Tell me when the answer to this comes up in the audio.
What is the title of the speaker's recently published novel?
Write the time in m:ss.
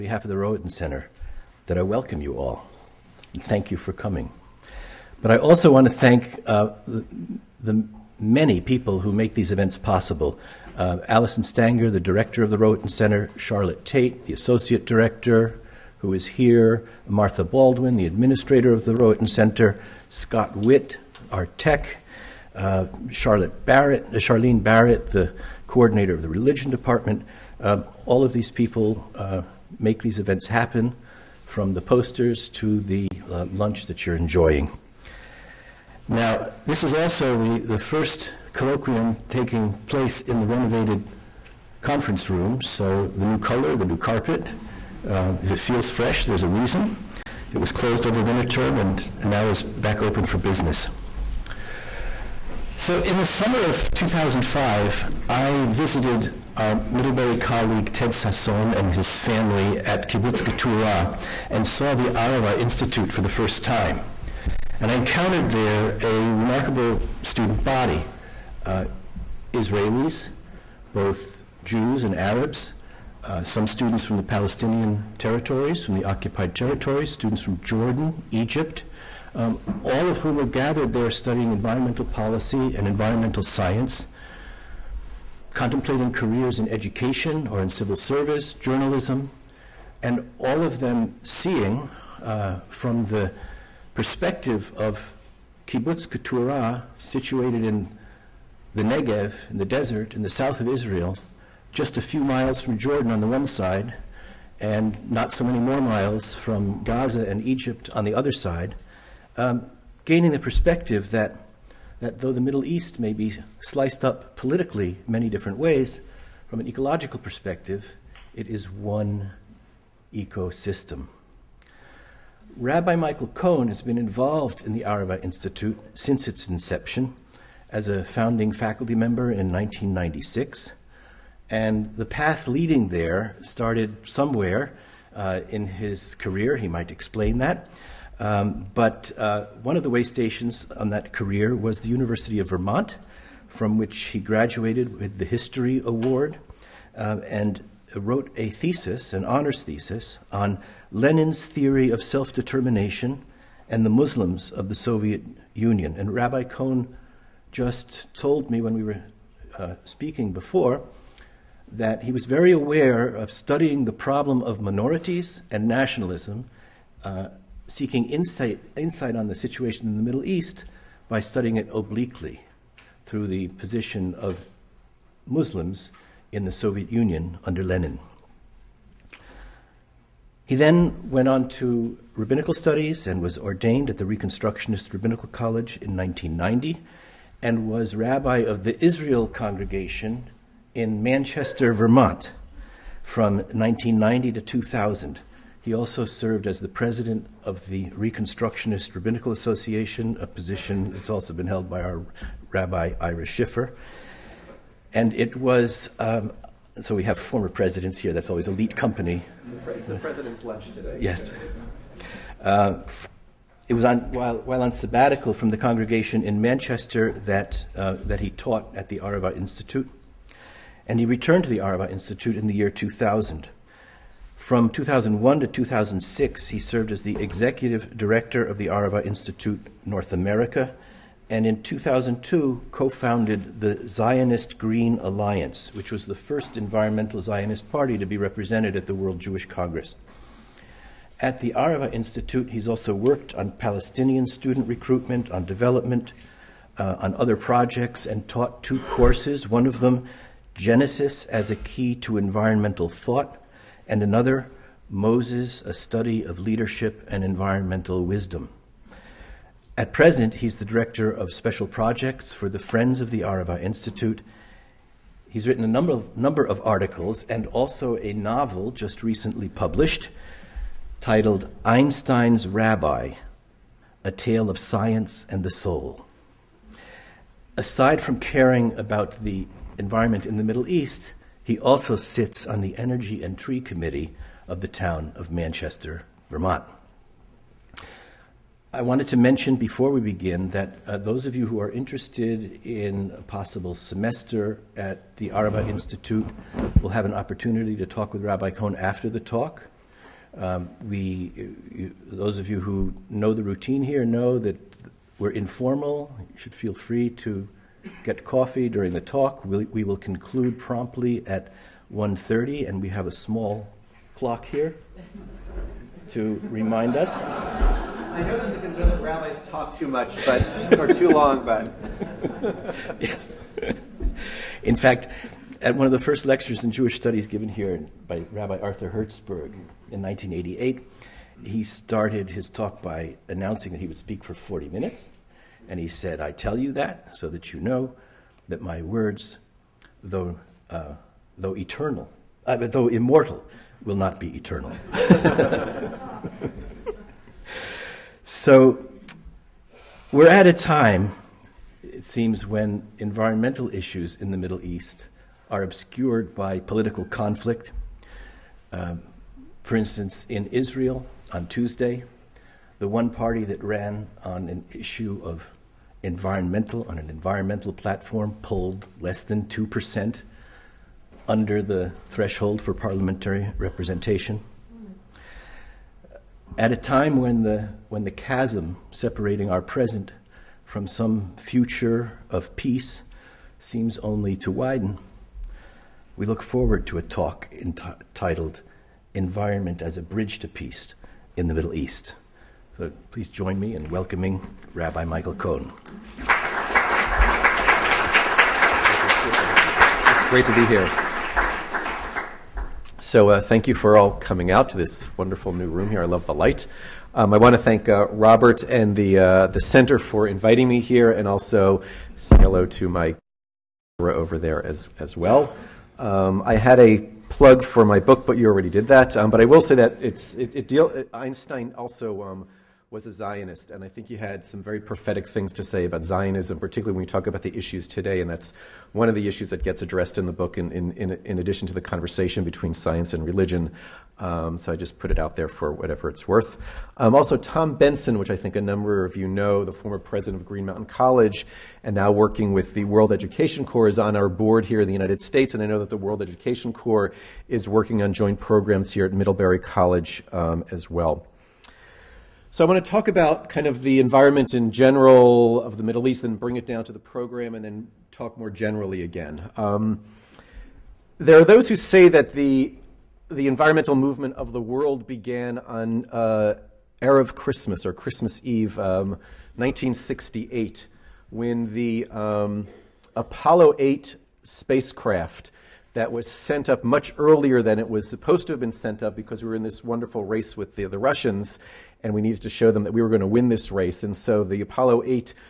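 4:31.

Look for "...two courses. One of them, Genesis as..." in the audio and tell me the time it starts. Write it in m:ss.
4:08.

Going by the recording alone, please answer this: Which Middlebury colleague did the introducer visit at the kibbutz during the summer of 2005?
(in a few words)
Ted Sasson.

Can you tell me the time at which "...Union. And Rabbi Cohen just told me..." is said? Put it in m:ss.
2:35.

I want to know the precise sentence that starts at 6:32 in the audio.
So please join me in welcoming Rabbi Michael Cohen.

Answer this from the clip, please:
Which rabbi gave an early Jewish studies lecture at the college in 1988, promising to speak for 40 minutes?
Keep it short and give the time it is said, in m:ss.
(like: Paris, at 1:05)
Arthur Hertzberg, at 5:28.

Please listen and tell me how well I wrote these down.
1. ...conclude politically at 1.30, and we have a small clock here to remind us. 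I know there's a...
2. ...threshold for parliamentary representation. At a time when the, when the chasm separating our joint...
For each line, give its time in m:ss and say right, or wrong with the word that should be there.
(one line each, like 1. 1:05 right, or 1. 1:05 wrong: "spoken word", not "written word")
1. 5:09 wrong: "promptly", not "politically"
2. 6:12 wrong: "present", not "joint".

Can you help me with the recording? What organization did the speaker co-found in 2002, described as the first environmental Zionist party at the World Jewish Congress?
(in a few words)
Zionist Green Alliance.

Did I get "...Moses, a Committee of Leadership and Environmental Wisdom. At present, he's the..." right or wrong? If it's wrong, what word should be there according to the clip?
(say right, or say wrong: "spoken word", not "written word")
wrong: "Study", not "Committee".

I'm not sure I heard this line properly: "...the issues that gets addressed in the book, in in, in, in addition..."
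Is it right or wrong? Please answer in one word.
right.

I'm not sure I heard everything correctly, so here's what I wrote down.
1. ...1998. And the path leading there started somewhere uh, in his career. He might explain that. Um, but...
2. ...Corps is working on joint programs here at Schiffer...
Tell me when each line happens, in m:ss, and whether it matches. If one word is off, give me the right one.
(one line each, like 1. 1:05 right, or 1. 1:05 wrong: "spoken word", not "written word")
1. 2:09 wrong: "1996", not "1998"
2. 7:26 wrong: "Middlebury", not "Schiffer".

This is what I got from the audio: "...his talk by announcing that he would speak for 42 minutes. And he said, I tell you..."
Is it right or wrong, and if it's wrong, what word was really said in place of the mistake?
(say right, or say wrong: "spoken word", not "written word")
wrong: "40", not "42".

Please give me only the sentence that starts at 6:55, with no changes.
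Um, I had a plug for my book, but you already did that.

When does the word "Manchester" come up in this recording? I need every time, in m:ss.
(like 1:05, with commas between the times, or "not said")
3:11, 3:36, 4:45.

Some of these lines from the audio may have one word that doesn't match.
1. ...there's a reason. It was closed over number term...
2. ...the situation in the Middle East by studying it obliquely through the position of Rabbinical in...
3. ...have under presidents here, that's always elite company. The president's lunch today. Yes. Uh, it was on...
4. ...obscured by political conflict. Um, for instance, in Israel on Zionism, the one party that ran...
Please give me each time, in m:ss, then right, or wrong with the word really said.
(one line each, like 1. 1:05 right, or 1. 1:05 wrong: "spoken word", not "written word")
1. 0:46 wrong: "winter", not "number"
2. 2:49 wrong: "Muslims", not "Rabbinical"
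3. 3:27 wrong: "former", not "under"
4. 5:55 wrong: "Tuesday", not "Zionism".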